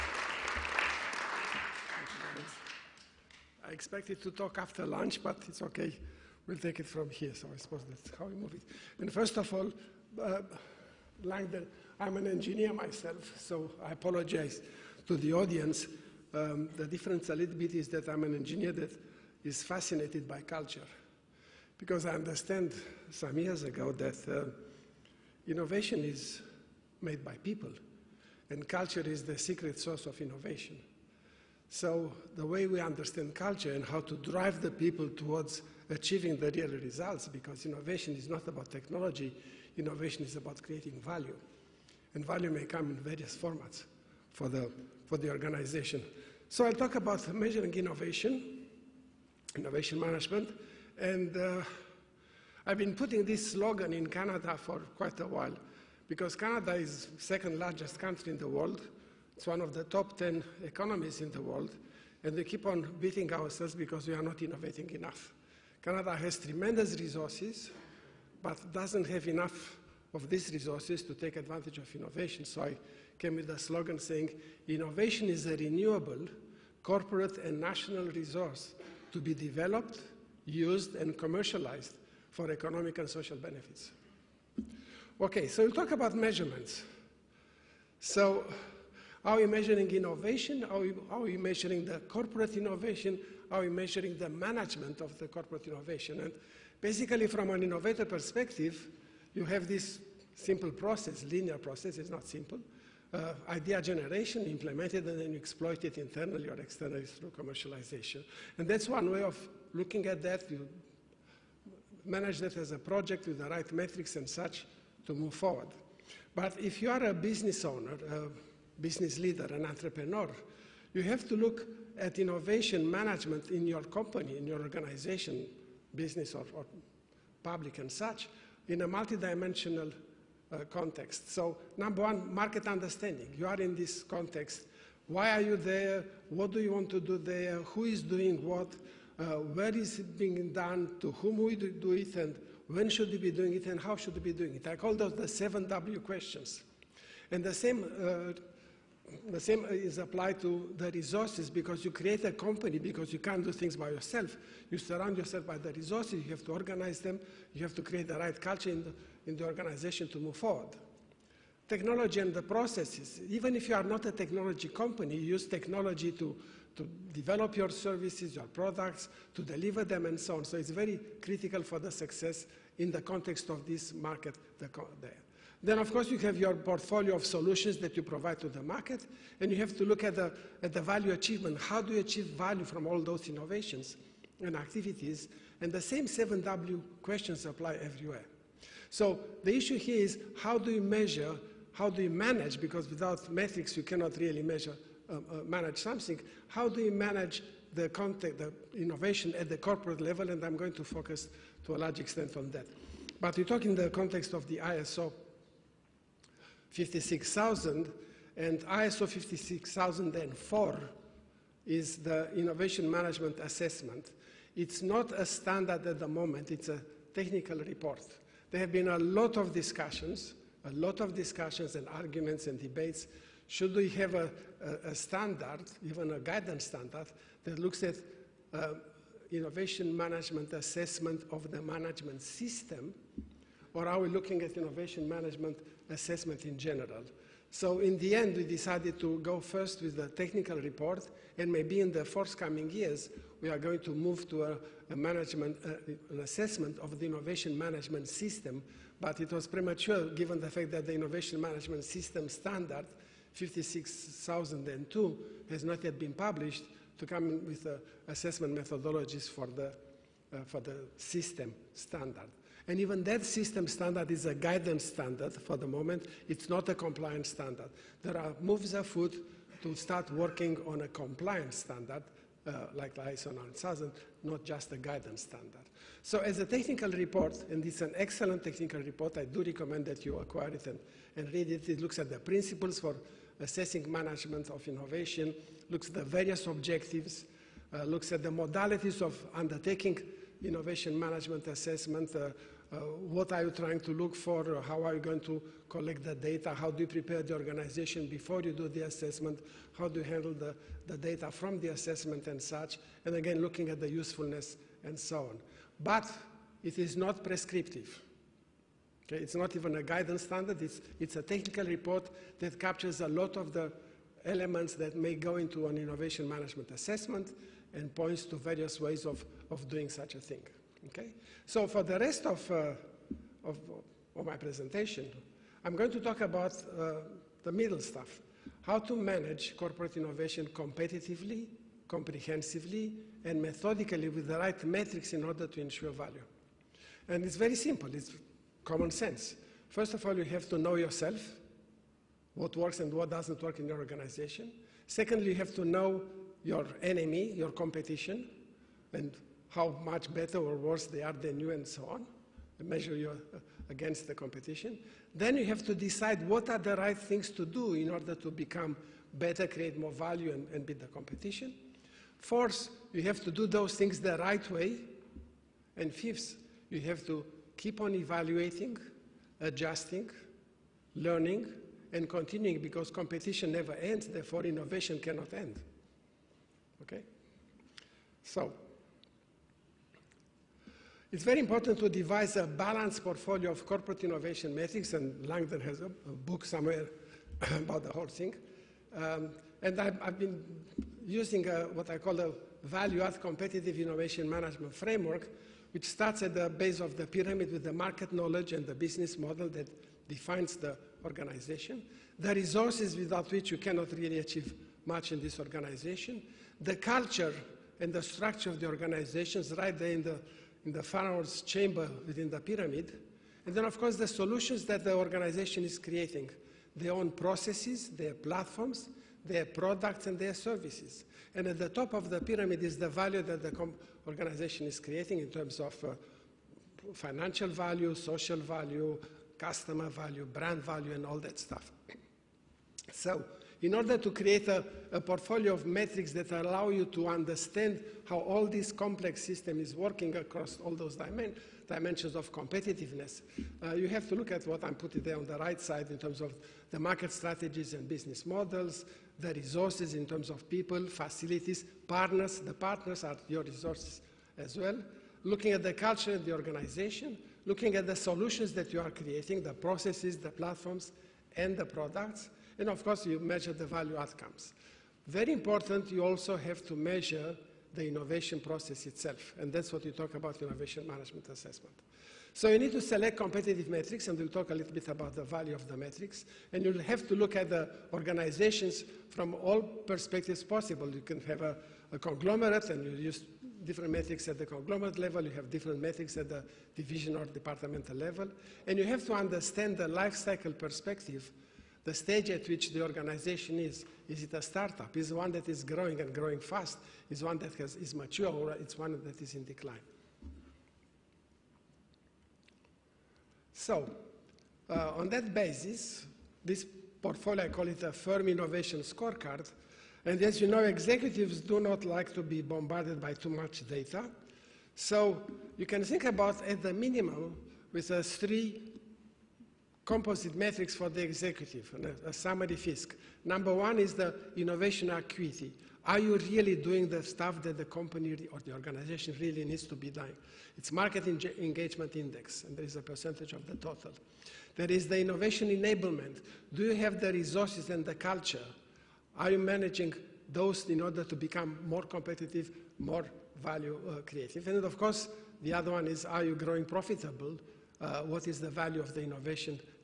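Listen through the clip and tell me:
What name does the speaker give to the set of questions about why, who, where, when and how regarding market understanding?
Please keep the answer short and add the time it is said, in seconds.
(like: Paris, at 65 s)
Seven W questions, at 145 s.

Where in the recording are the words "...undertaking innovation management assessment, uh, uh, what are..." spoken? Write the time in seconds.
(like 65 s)
289 s.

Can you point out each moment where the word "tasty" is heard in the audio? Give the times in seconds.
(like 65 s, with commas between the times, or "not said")
not said.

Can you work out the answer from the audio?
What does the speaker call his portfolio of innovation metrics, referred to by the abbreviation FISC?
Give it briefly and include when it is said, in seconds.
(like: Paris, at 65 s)
Firm innovation scorecard, at 507 s.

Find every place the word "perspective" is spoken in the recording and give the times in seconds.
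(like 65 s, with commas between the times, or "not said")
98 s, 479 s, 490 s.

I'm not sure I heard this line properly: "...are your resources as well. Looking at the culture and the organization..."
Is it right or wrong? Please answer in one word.
right.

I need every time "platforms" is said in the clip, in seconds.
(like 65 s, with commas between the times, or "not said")
418 s, 460 s.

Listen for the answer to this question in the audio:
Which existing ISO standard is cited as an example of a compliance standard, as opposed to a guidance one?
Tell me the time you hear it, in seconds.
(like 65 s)
272 s.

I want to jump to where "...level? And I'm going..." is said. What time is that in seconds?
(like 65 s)
199 s.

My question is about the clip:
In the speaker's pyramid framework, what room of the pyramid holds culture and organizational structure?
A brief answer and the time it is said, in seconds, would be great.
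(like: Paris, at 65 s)
The pharaoh's chamber, at 410 s.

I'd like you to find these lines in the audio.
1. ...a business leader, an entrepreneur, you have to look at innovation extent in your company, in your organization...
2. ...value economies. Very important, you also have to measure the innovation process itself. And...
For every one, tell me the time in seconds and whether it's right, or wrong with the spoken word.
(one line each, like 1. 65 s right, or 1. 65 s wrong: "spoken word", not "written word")
1. 118 s wrong: "management", not "extent"
2. 463 s wrong: "outcomes", not "economies".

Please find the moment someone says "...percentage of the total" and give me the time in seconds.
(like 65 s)
532 s.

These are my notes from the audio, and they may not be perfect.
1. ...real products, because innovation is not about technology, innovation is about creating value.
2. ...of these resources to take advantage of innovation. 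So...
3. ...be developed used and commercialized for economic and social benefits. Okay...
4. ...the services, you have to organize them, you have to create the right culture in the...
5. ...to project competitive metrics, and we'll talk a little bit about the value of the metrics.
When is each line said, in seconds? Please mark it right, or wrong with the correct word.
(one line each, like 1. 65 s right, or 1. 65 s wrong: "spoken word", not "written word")
1. 36 s wrong: "results", not "products"
2. 70 s right
3. 79 s right
4. 155 s wrong: "resources", not "services"
5. 472 s wrong: "select", not "project".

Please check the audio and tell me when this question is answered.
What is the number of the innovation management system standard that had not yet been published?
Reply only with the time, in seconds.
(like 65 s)
253 s.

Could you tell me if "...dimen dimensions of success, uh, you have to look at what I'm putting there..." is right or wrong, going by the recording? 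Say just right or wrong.
wrong.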